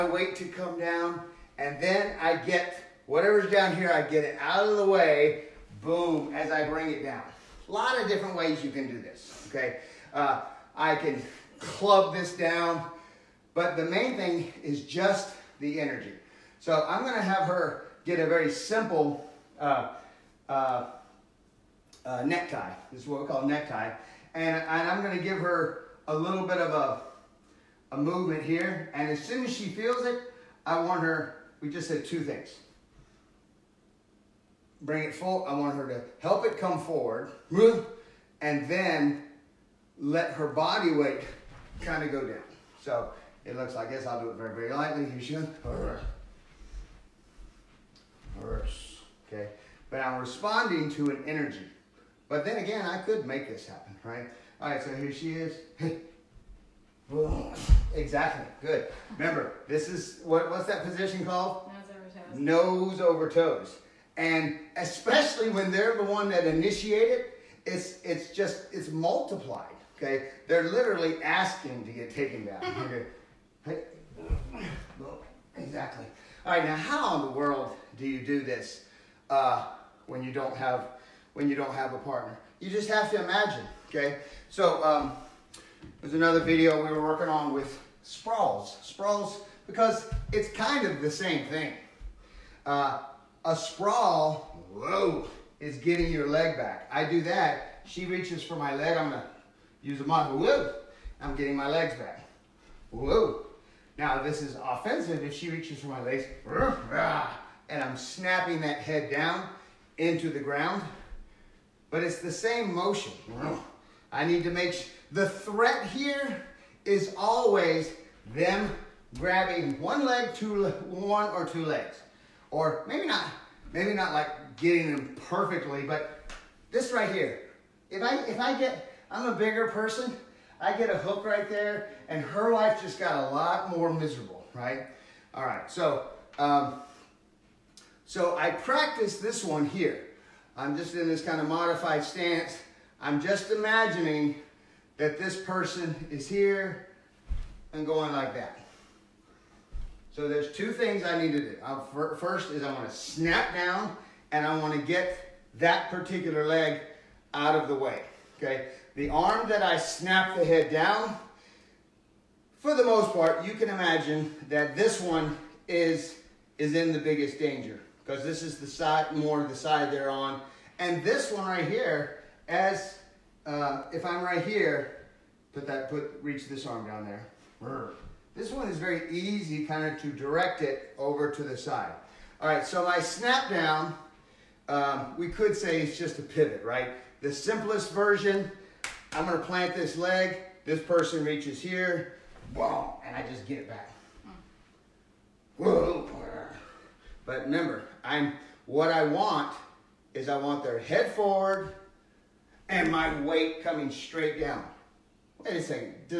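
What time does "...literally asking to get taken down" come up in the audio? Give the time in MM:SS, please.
01:10.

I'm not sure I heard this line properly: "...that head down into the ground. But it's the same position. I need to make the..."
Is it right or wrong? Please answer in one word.
wrong.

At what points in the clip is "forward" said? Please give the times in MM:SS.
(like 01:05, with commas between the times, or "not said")
00:36, 03:21.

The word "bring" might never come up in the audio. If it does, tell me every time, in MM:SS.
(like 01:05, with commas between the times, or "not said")
00:06, 00:34.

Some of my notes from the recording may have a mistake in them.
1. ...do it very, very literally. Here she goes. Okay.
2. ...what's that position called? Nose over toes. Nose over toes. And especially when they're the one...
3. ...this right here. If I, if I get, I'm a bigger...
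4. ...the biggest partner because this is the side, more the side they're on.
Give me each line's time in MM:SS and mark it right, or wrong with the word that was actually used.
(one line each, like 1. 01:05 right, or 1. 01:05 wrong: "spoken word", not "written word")
1. 00:44 wrong: "lightly", not "literally"
2. 01:00 right
3. 02:06 right
4. 02:46 wrong: "danger", not "partner".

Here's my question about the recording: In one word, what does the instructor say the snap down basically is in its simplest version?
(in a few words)
A pivot.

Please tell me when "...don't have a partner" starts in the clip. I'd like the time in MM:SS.
01:21.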